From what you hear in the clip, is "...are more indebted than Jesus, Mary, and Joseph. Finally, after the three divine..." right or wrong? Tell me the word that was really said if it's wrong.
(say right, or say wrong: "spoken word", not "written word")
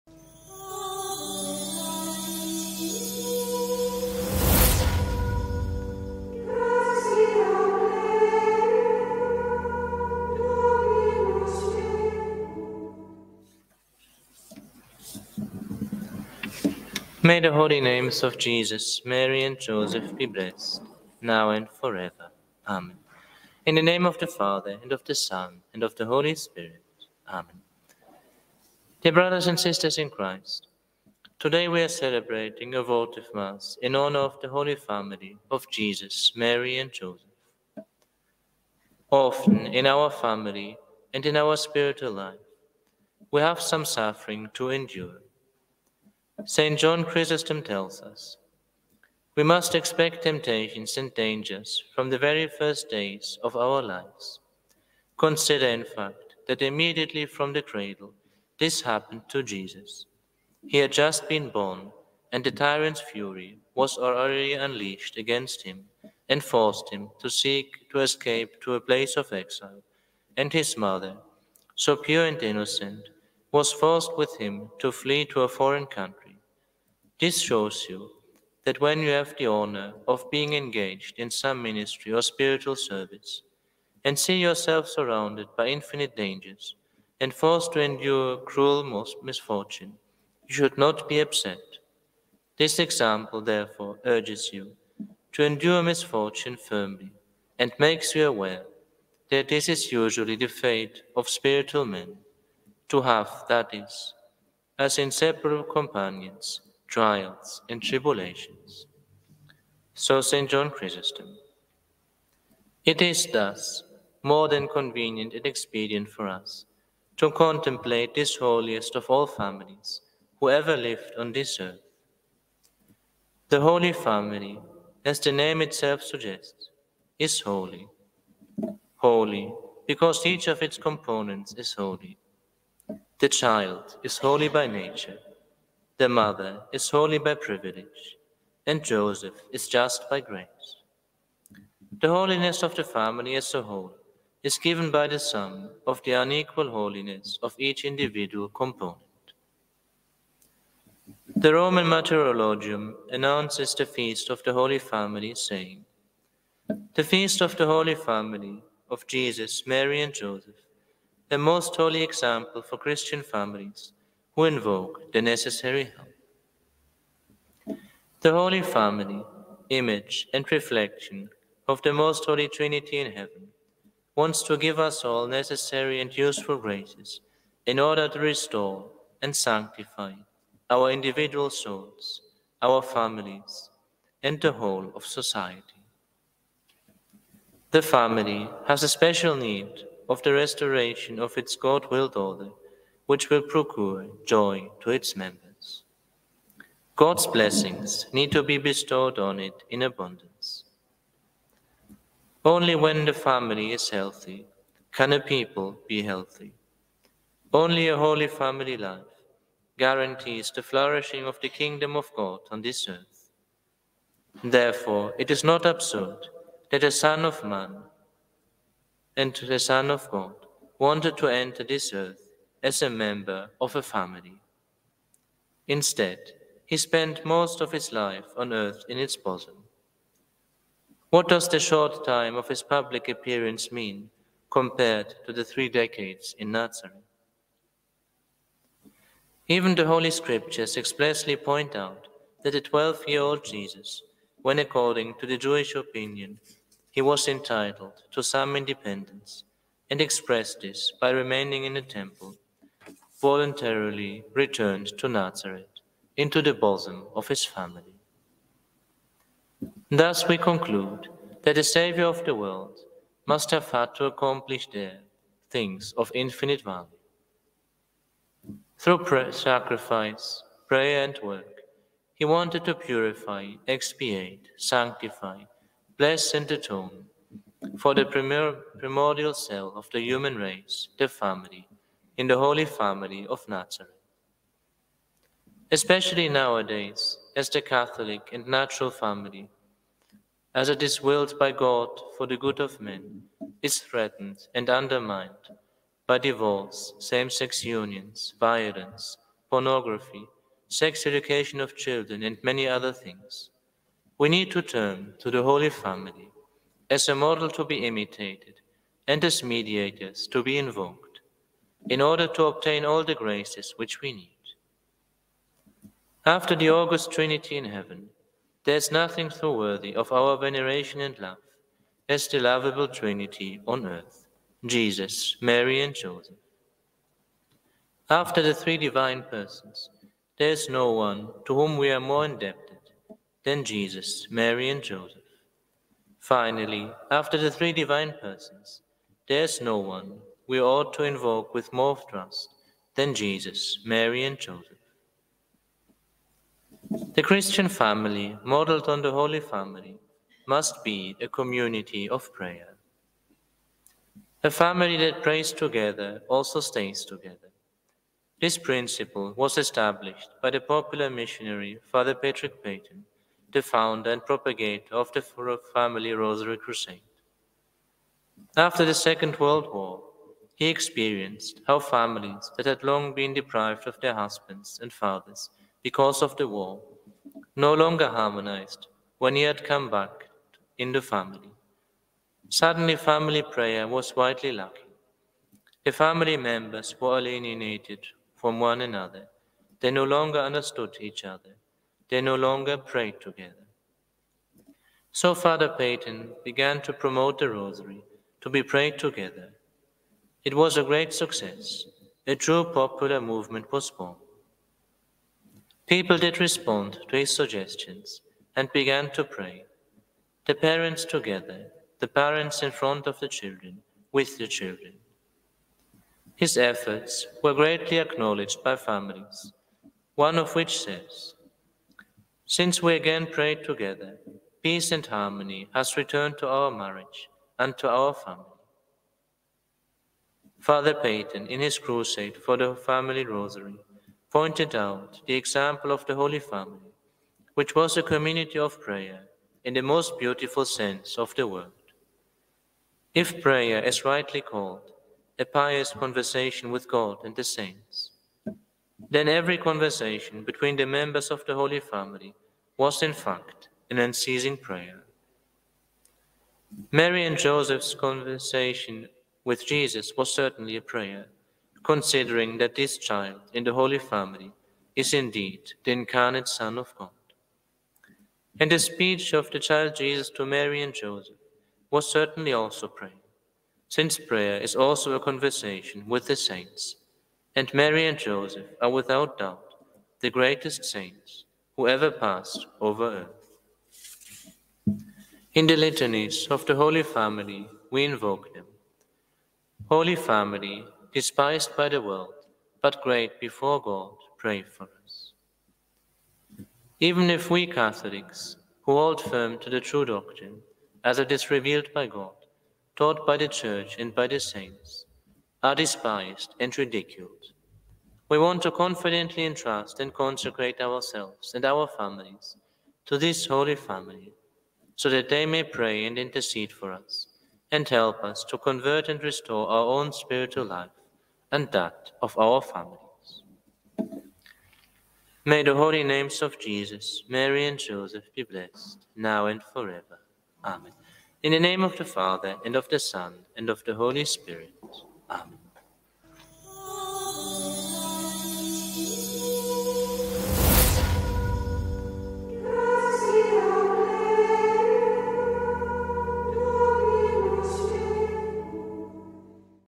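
right.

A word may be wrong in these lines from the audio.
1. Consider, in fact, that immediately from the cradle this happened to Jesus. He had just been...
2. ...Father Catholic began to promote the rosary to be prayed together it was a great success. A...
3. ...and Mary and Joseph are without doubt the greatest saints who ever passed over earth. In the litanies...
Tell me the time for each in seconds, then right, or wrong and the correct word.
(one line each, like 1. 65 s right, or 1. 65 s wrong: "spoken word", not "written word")
1. 55 s right
2. 395 s wrong: "Peyton", not "Catholic"
3. 477 s right.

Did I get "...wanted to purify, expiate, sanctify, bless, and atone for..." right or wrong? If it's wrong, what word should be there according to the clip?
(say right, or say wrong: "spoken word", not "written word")
right.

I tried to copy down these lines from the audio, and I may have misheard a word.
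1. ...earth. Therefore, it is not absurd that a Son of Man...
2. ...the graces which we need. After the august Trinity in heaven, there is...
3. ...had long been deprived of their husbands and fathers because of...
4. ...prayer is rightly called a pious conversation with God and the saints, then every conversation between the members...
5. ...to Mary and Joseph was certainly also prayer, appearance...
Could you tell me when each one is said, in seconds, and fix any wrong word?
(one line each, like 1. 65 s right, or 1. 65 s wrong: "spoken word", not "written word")
1. 212 s right
2. 313 s right
3. 372 s right
4. 443 s right
5. 470 s wrong: "since", not "appearance".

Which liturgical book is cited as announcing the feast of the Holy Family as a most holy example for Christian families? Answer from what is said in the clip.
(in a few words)
Roman Martyrologium.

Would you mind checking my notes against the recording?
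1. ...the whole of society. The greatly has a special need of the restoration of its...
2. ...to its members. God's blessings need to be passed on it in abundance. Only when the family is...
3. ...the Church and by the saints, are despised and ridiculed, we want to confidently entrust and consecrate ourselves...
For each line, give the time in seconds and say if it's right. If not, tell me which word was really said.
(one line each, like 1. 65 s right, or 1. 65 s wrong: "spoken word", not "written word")
1. 184 s wrong: "family", not "greatly"
2. 194 s wrong: "bestowed", not "passed"
3. 503 s right.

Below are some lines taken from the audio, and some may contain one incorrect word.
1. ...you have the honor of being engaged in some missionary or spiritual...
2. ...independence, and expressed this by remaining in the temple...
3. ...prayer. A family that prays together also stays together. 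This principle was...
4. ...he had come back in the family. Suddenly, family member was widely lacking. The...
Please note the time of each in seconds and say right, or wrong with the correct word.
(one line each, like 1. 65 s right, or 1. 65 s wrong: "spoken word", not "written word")
1. 78 s wrong: "ministry", not "missionary"
2. 248 s right
3. 352 s right
4. 379 s wrong: "prayer", not "member".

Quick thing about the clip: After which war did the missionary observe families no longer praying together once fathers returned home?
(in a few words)
Second World War.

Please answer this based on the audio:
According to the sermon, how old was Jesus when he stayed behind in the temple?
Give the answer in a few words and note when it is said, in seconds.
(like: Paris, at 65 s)
12, at 242 s.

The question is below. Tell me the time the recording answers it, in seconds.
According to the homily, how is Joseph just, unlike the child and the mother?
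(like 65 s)
140 s.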